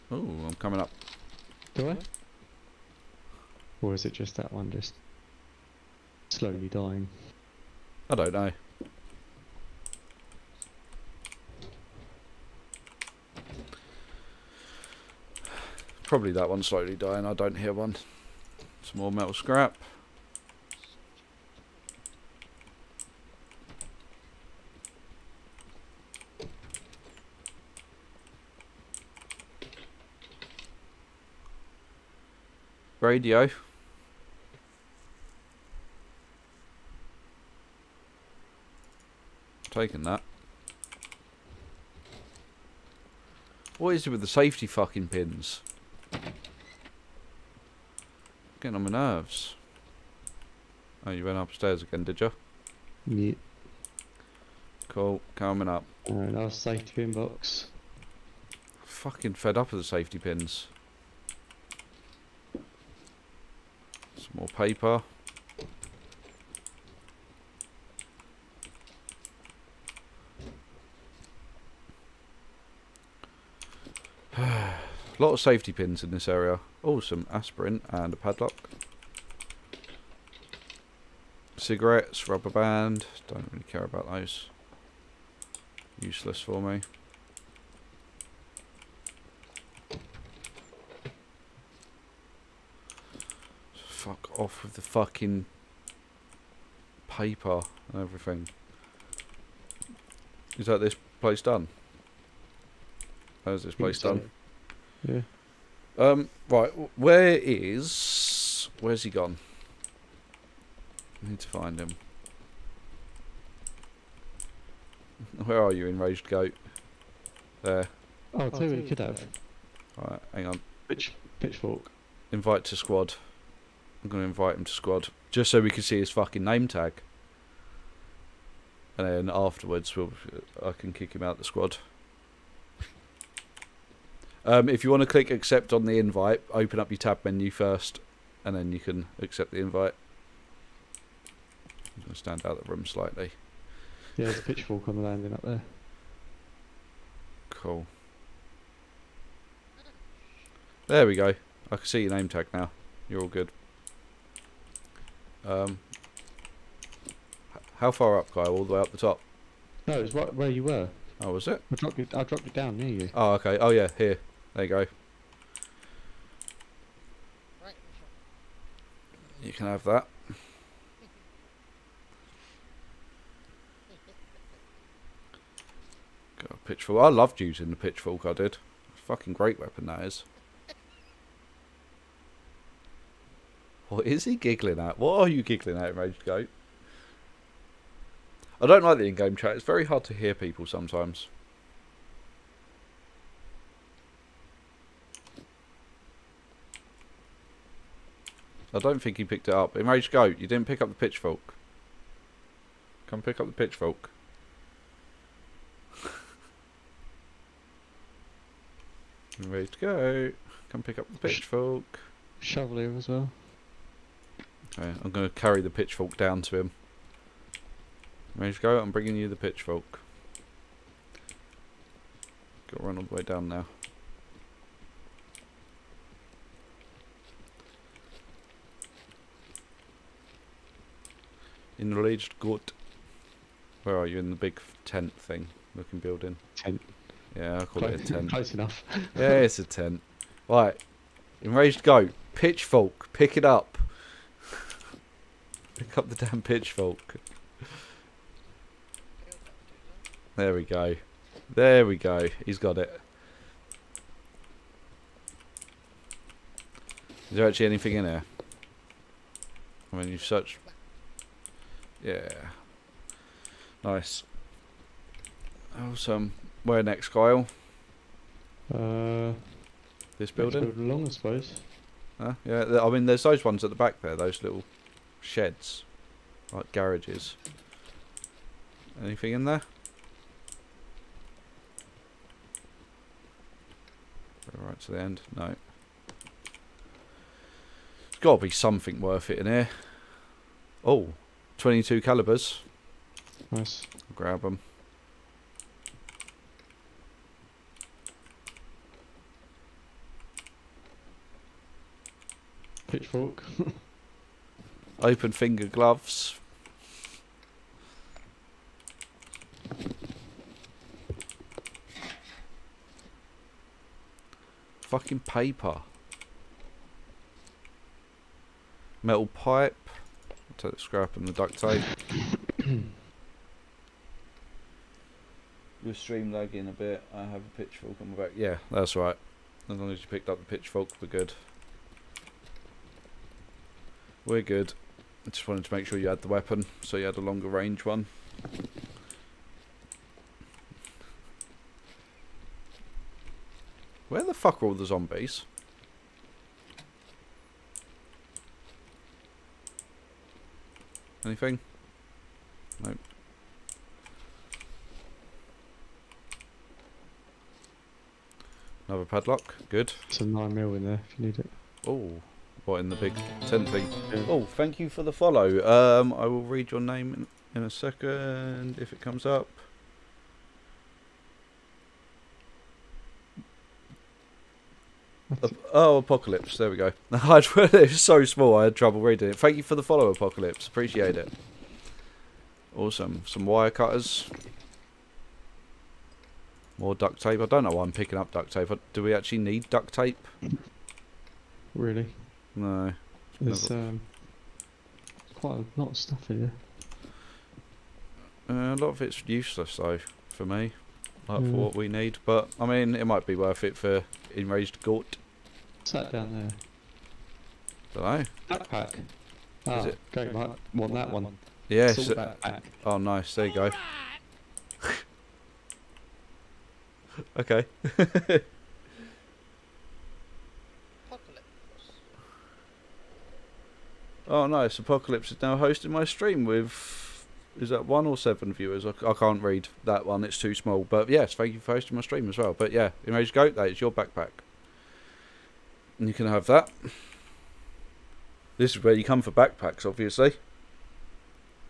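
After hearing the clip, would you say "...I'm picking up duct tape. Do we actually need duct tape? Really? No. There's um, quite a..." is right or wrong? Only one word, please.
right.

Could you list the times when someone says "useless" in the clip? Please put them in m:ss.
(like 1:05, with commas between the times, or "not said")
1:26, 6:39.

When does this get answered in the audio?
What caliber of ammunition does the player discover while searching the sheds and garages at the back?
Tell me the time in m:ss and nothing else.
4:51.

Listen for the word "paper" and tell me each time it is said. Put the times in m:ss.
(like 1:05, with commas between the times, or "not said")
1:04, 1:37, 5:15.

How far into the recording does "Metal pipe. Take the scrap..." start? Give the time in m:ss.
5:19.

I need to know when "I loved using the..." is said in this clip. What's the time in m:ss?
2:57.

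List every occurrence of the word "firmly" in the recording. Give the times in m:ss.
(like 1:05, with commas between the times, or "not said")
not said.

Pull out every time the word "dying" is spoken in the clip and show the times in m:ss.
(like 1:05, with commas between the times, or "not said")
0:06, 0:16.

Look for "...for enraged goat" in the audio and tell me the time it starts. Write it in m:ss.
6:43.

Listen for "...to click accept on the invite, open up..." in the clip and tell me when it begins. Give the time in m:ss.
2:15.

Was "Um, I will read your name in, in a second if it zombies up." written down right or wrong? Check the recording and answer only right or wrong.
wrong.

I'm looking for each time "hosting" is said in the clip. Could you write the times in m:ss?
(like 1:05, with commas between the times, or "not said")
7:05, 7:11.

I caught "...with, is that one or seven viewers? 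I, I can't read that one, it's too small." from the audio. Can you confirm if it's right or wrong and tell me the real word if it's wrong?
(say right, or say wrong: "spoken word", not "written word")
right.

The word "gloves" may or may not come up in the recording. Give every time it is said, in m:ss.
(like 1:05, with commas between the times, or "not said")
5:05.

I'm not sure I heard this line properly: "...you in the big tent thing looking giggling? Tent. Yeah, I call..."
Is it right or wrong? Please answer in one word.
wrong.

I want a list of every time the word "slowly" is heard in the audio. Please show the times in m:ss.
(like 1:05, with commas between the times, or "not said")
0:06, 0:16.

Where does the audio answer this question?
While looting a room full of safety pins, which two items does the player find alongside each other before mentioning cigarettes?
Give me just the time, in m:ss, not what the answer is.
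1:17.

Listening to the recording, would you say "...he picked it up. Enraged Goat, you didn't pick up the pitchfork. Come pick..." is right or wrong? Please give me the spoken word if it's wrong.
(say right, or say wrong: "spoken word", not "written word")
right.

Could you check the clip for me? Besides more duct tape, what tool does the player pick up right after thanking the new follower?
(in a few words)
wire cutters.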